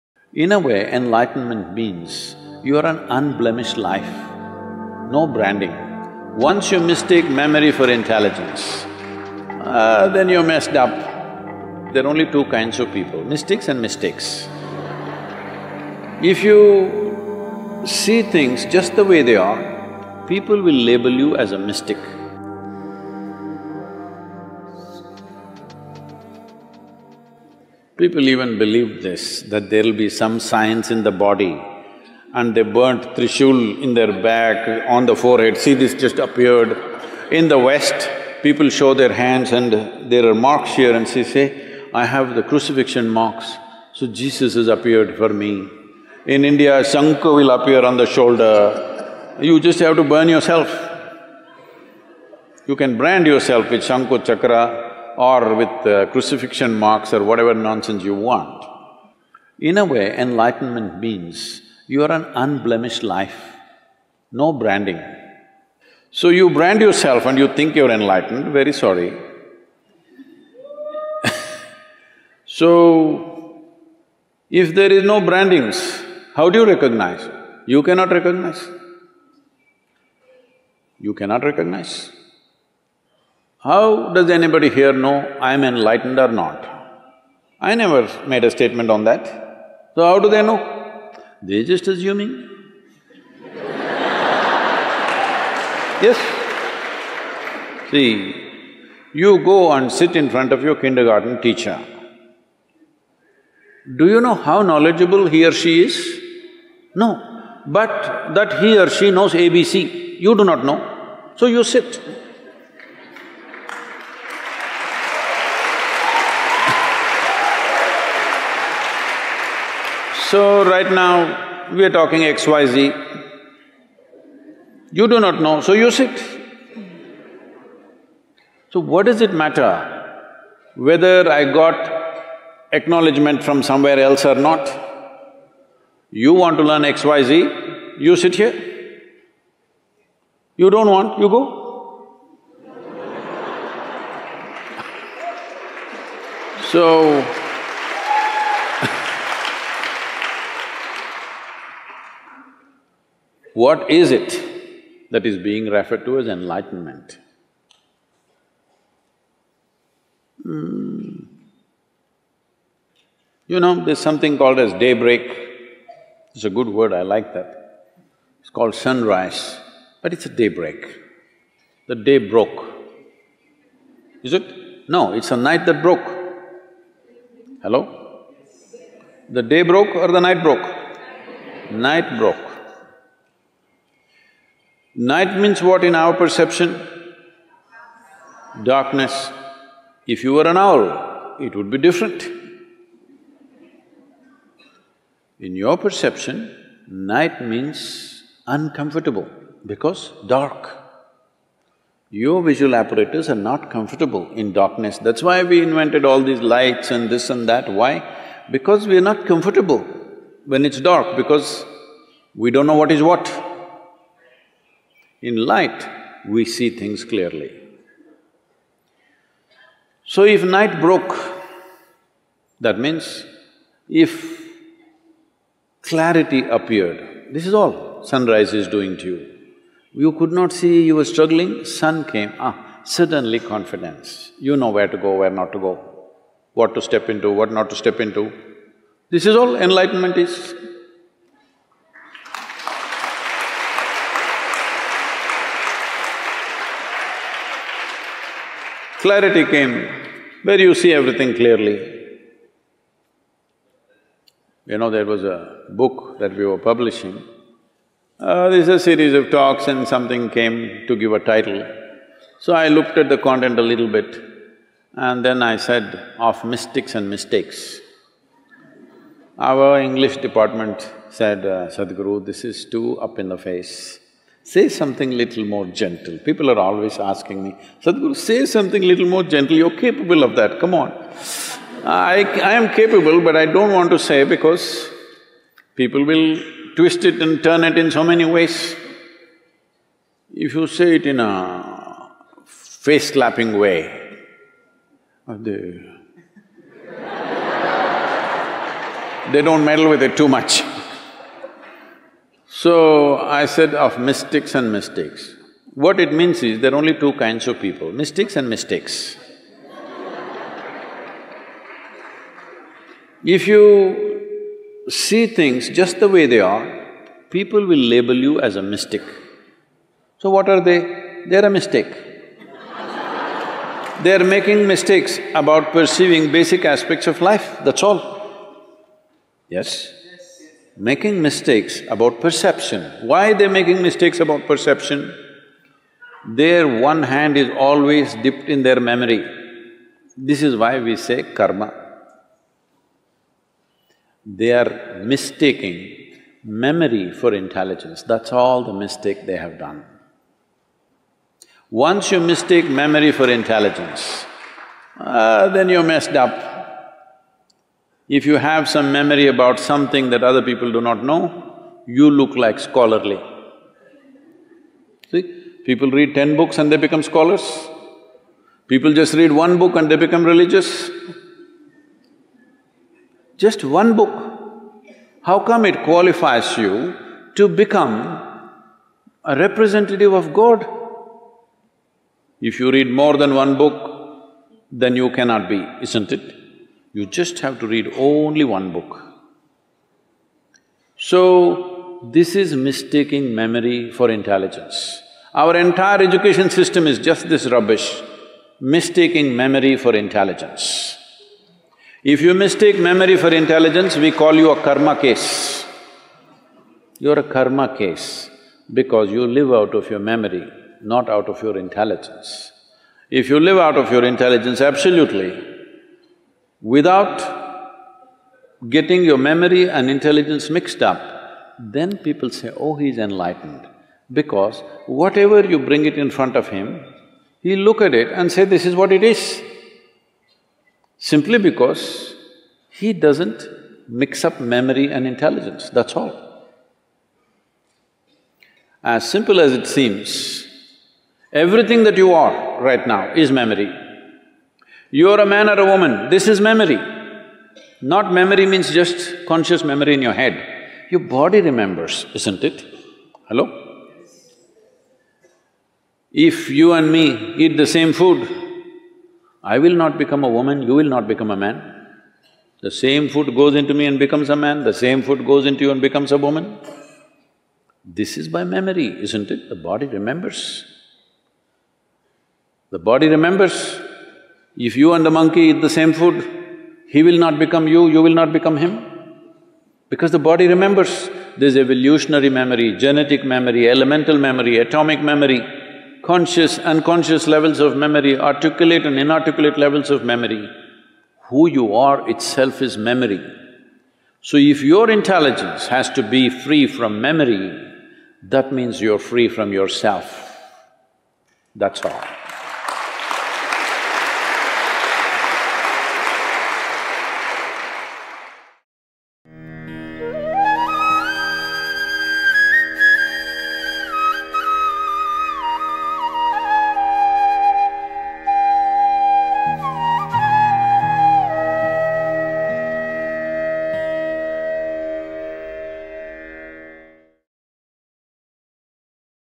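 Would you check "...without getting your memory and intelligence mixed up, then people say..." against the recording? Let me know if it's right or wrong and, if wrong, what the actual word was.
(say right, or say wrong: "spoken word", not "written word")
right.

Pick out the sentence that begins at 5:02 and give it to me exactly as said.
So, I said of mystics and mistakes, what it means is there are only two kinds of people, mystics and mistakes.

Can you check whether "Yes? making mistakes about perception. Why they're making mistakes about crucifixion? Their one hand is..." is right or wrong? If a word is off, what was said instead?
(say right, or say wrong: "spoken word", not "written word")
wrong: "perception", not "crucifixion".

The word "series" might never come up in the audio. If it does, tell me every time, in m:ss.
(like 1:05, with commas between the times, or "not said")
4:18.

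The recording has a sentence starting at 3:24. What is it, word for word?
That's why we invented all these lights and this and that.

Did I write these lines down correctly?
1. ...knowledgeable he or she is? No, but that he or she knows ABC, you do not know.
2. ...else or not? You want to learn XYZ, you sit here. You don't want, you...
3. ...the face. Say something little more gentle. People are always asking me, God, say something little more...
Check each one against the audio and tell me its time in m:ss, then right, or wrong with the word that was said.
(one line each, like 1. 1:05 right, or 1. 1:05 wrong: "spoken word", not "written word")
1. 1:44 right
2. 2:13 right
3. 4:33 wrong: "Sadhguru", not "God".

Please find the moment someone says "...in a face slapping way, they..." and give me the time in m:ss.
4:51.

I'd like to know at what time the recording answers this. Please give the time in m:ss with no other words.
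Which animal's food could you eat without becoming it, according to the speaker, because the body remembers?
7:55.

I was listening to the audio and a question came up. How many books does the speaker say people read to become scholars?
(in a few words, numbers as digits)
10.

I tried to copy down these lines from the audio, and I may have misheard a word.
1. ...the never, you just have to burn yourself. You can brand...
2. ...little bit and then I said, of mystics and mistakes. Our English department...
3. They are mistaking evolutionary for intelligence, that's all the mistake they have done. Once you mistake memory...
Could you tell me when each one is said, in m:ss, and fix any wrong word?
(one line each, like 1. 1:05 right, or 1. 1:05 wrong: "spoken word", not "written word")
1. 0:47 wrong: "shoulder", not "never"
2. 4:23 right
3. 5:44 wrong: "memory", not "evolutionary".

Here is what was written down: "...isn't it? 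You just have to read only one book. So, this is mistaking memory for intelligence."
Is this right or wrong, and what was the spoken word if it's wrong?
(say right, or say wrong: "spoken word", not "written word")
right.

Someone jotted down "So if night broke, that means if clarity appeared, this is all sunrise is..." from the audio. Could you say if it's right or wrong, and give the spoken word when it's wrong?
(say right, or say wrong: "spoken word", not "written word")
right.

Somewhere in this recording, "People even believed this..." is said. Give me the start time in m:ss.
0:28.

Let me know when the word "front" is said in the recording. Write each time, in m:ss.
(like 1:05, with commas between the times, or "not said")
1:40, 7:06.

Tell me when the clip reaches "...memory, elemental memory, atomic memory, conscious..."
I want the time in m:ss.
8:03.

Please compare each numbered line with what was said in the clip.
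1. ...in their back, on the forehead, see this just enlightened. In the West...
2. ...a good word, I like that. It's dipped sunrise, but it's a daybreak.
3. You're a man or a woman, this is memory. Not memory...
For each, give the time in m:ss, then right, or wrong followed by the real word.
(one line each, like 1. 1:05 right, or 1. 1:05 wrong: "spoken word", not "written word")
1. 0:33 wrong: "appeared", not "enlightened"
2. 2:46 wrong: "called", not "dipped"
3. 7:24 right.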